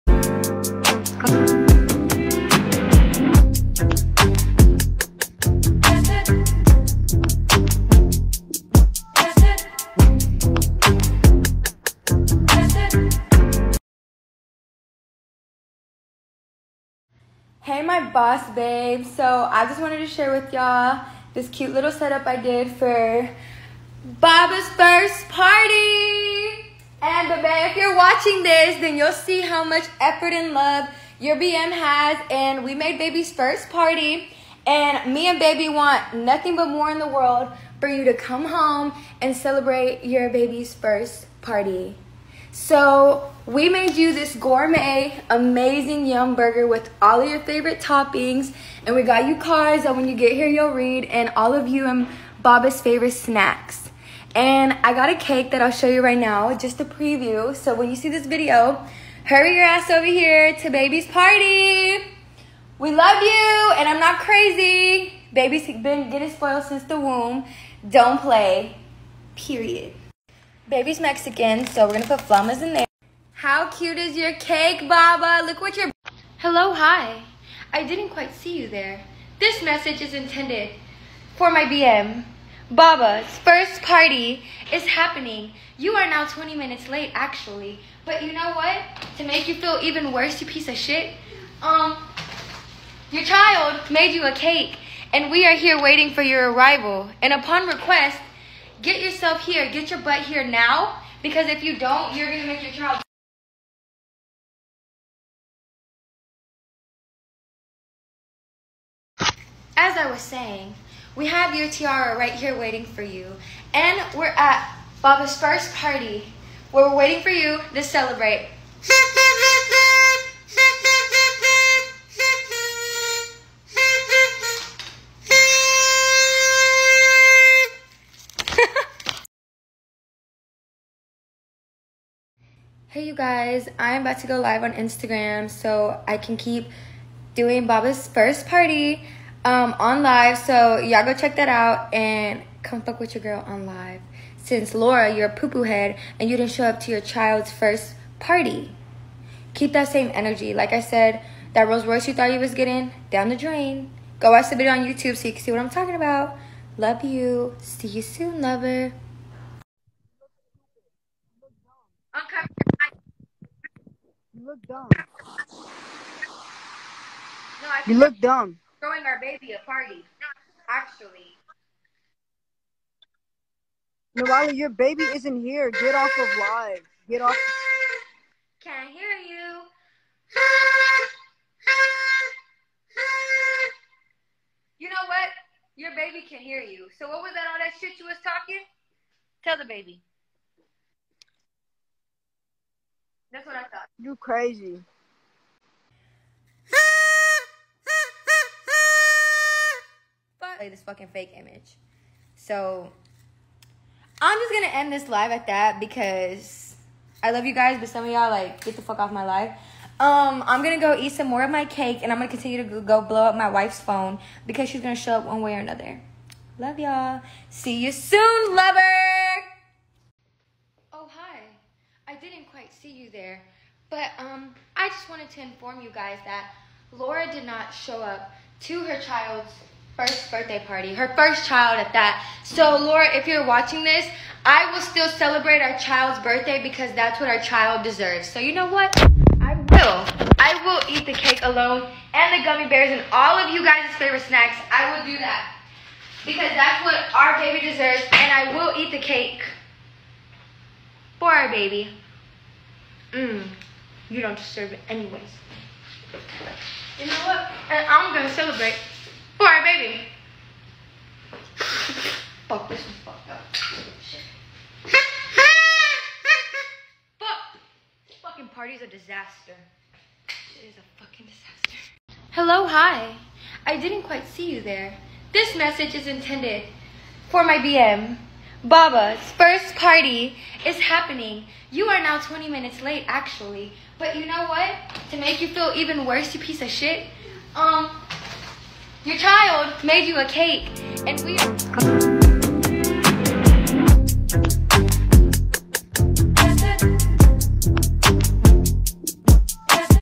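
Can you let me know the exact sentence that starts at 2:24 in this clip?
Since Laura, you're a poo-poo head and you didn't show up to your child's first party.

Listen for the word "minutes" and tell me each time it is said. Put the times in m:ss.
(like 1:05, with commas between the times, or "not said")
1:26, 4:42.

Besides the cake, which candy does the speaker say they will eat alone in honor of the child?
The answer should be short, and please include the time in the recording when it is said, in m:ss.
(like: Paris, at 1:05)
gummy bears, at 4:02.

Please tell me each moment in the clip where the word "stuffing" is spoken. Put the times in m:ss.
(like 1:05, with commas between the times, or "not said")
not said.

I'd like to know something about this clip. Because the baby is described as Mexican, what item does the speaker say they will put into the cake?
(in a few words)
flamas.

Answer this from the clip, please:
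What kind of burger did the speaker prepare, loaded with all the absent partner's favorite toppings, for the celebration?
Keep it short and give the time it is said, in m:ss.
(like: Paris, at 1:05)
yum burger, at 0:46.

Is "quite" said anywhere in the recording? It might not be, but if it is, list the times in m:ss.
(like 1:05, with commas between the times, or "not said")
1:18, 3:42, 4:34.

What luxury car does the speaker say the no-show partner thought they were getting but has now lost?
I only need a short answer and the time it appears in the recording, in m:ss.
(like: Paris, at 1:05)
Rolls Royce, at 2:31.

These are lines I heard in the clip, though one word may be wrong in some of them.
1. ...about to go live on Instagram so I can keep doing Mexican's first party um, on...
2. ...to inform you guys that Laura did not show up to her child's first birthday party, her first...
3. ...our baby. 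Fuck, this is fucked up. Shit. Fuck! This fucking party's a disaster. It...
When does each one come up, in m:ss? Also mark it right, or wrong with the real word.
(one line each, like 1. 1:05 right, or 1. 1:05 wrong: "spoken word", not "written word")
1. 2:14 wrong: "Baba", not "Mexican"
2. 3:45 right
3. 4:19 right.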